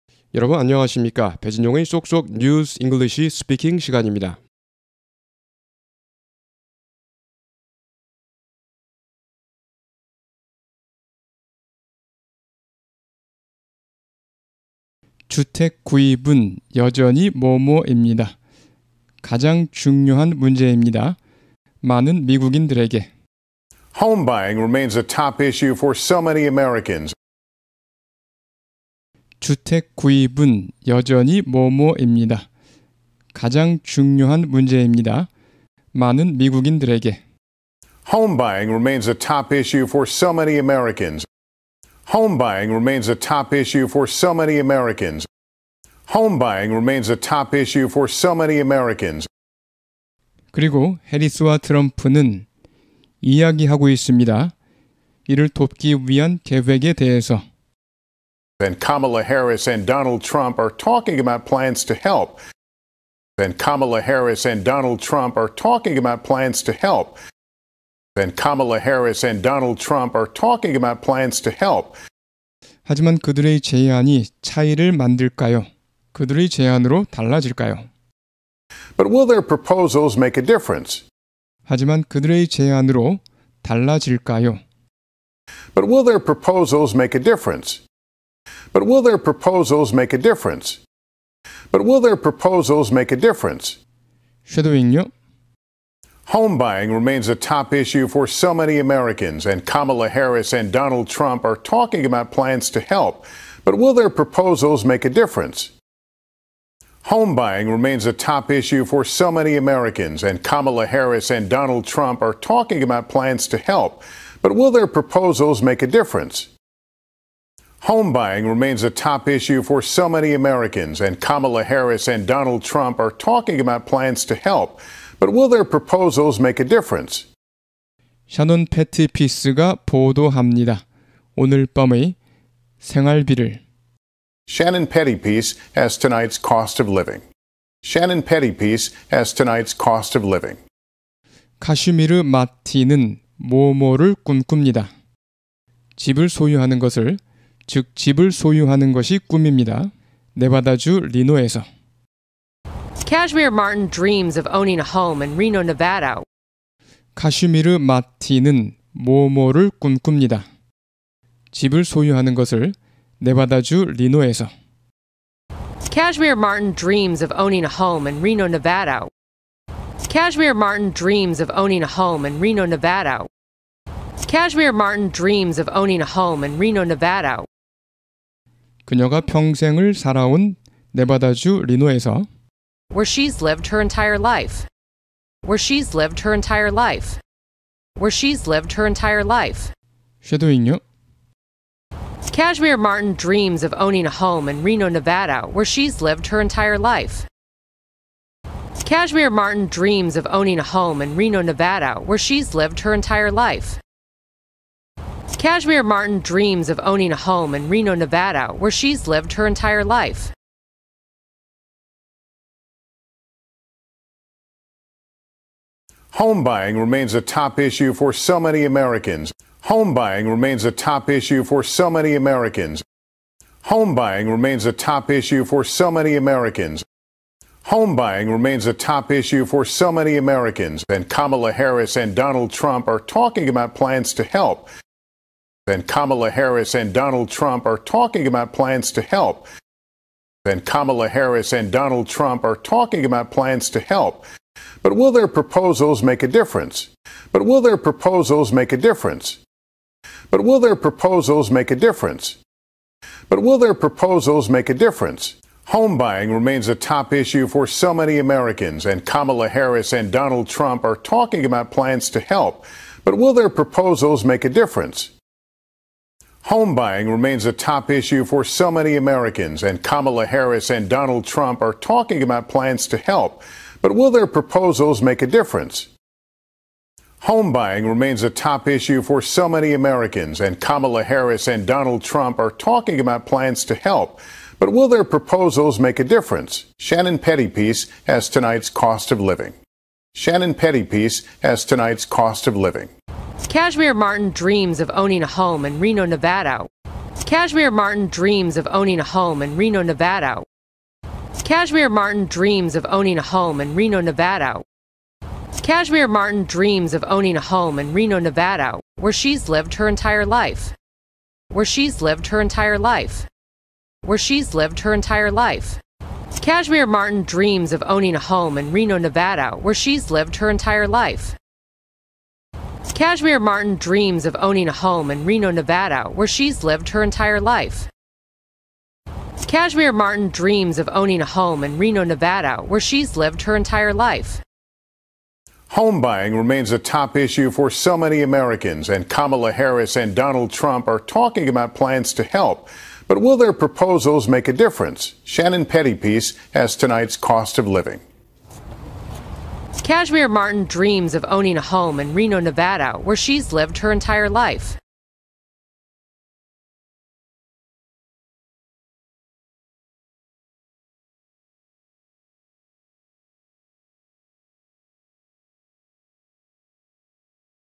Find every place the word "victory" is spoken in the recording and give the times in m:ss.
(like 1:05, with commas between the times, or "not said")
not said.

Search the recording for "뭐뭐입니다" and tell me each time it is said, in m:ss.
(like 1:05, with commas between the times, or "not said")
0:17, 0:31.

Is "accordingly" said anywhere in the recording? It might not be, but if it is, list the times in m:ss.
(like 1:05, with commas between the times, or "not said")
not said.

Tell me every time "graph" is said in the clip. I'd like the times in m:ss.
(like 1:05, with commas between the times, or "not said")
not said.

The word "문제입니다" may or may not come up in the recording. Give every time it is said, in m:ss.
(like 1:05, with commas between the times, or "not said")
0:20, 0:34.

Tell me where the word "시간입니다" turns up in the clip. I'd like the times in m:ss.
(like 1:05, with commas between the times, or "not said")
0:03.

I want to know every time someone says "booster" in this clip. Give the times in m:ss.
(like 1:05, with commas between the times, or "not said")
not said.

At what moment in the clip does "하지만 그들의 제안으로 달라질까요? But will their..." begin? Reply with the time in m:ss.
1:21.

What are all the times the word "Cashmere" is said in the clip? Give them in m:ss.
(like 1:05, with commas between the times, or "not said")
2:33, 2:45, 2:50, 2:54.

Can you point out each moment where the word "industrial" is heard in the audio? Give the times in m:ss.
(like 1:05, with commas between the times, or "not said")
not said.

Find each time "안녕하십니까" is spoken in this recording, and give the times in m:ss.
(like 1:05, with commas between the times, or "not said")
0:00.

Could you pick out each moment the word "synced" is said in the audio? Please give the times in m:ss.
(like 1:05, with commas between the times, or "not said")
not said.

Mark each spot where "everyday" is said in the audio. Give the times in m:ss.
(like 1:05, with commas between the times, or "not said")
not said.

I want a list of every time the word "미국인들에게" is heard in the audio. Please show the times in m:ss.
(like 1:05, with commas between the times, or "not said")
0:22, 0:36.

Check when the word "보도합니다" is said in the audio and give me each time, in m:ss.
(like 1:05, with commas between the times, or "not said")
2:09.